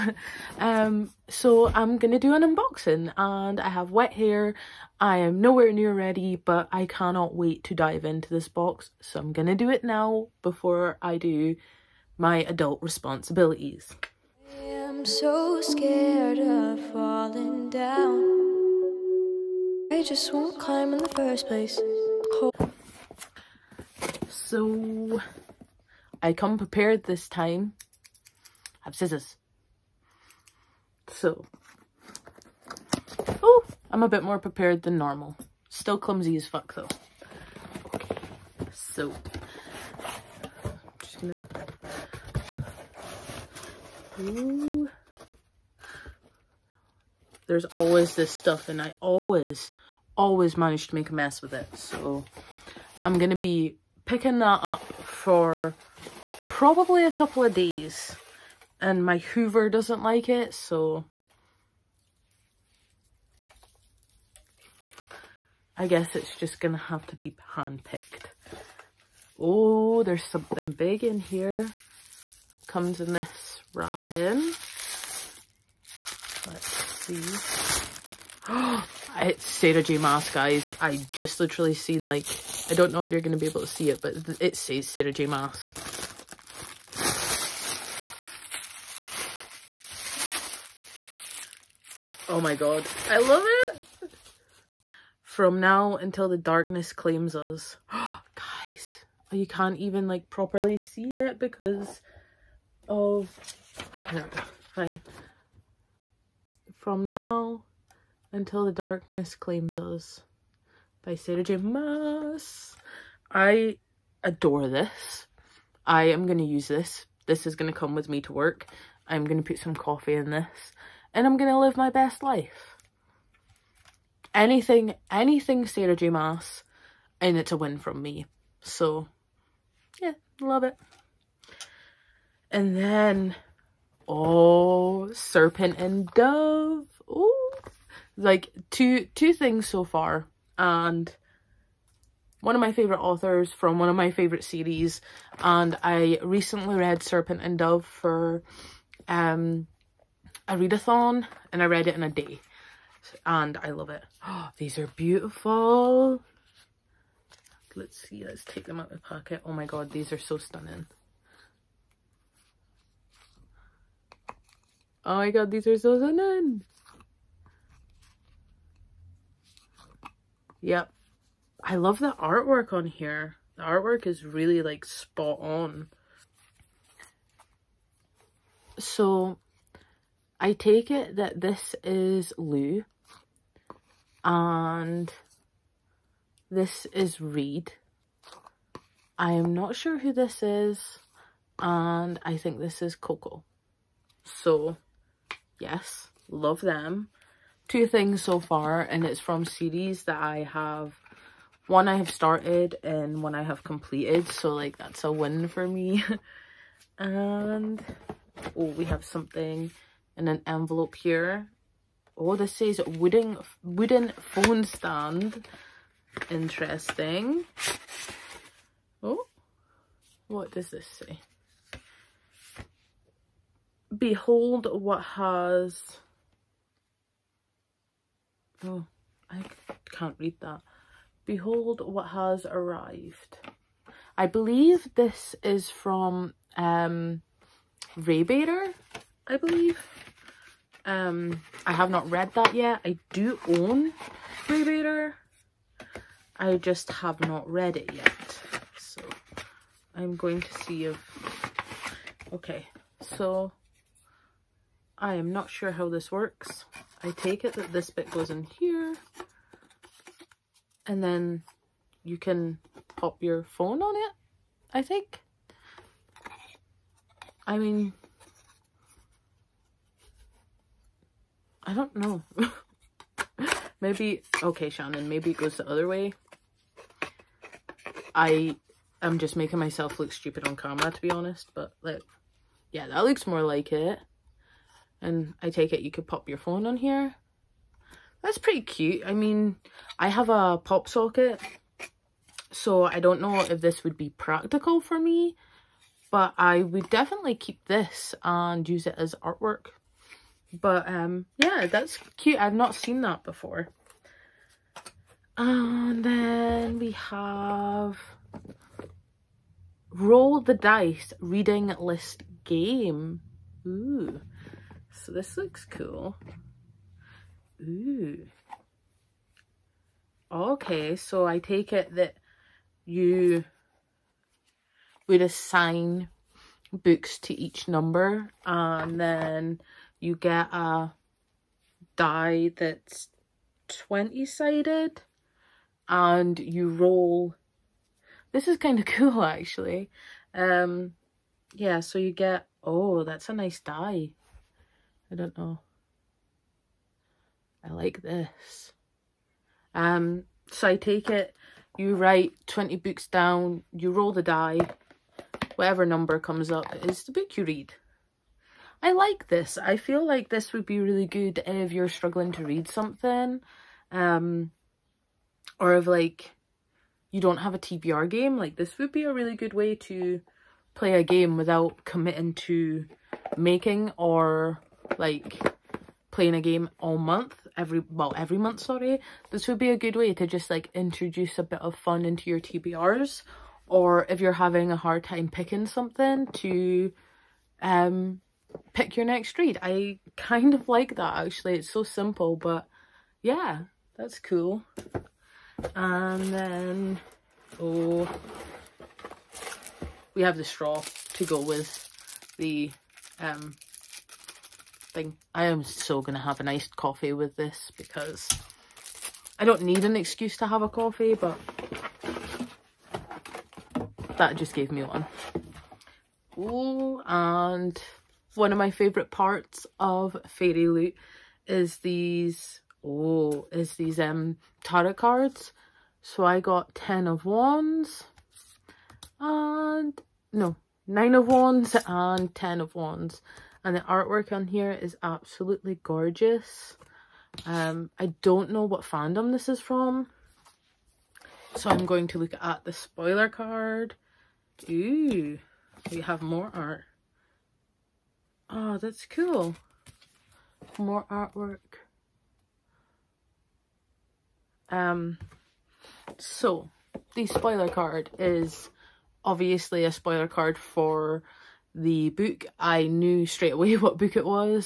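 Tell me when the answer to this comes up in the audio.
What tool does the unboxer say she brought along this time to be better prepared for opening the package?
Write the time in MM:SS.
00:28.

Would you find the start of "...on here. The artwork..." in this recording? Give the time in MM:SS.
02:52.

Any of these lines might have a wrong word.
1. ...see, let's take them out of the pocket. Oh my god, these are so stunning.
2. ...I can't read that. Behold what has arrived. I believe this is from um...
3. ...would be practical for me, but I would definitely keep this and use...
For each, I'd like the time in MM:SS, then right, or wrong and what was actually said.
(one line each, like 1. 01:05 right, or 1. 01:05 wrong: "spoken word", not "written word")
1. 02:37 right
2. 03:49 right
3. 04:53 right.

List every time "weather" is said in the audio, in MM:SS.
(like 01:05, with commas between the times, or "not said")
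not said.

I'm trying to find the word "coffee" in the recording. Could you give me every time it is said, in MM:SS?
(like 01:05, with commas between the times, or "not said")
01:59, 06:46, 06:50.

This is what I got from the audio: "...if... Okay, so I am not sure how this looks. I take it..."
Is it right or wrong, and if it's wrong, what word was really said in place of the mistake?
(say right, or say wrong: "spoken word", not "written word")
wrong: "works", not "looks".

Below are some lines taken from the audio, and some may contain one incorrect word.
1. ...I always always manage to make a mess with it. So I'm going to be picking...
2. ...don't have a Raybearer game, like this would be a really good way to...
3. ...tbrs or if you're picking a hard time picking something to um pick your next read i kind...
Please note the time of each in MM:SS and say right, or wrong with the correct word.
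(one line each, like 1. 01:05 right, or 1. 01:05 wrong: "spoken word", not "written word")
1. 00:48 right
2. 06:07 wrong: "TBR", not "Raybearer"
3. 06:22 wrong: "having", not "picking".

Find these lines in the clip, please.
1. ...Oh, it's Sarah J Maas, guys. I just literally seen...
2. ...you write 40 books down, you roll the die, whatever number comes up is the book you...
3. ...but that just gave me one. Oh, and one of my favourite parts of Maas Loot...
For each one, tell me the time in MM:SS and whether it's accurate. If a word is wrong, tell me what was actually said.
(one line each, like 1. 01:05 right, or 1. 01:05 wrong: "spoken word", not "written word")
1. 01:18 right
2. 05:51 wrong: "20", not "40"
3. 06:51 wrong: "Fairy", not "Maas".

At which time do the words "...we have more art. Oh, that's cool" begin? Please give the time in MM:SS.
07:25.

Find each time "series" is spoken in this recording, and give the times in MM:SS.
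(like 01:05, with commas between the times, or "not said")
02:24, 03:19.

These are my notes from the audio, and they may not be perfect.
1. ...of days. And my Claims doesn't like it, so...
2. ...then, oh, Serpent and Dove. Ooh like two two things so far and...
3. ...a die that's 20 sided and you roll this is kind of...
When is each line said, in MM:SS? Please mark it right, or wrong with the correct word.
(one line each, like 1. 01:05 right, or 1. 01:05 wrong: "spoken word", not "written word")
1. 00:57 wrong: "Hoover", not "Claims"
2. 02:12 right
3. 05:30 right.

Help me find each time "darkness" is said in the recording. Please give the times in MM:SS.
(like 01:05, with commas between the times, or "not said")
01:36, 01:48.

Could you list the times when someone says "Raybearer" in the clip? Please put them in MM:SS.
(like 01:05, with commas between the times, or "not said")
03:57, 04:04.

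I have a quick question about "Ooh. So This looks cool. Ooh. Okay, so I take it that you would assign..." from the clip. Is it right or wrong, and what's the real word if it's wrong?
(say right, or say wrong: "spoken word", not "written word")
right.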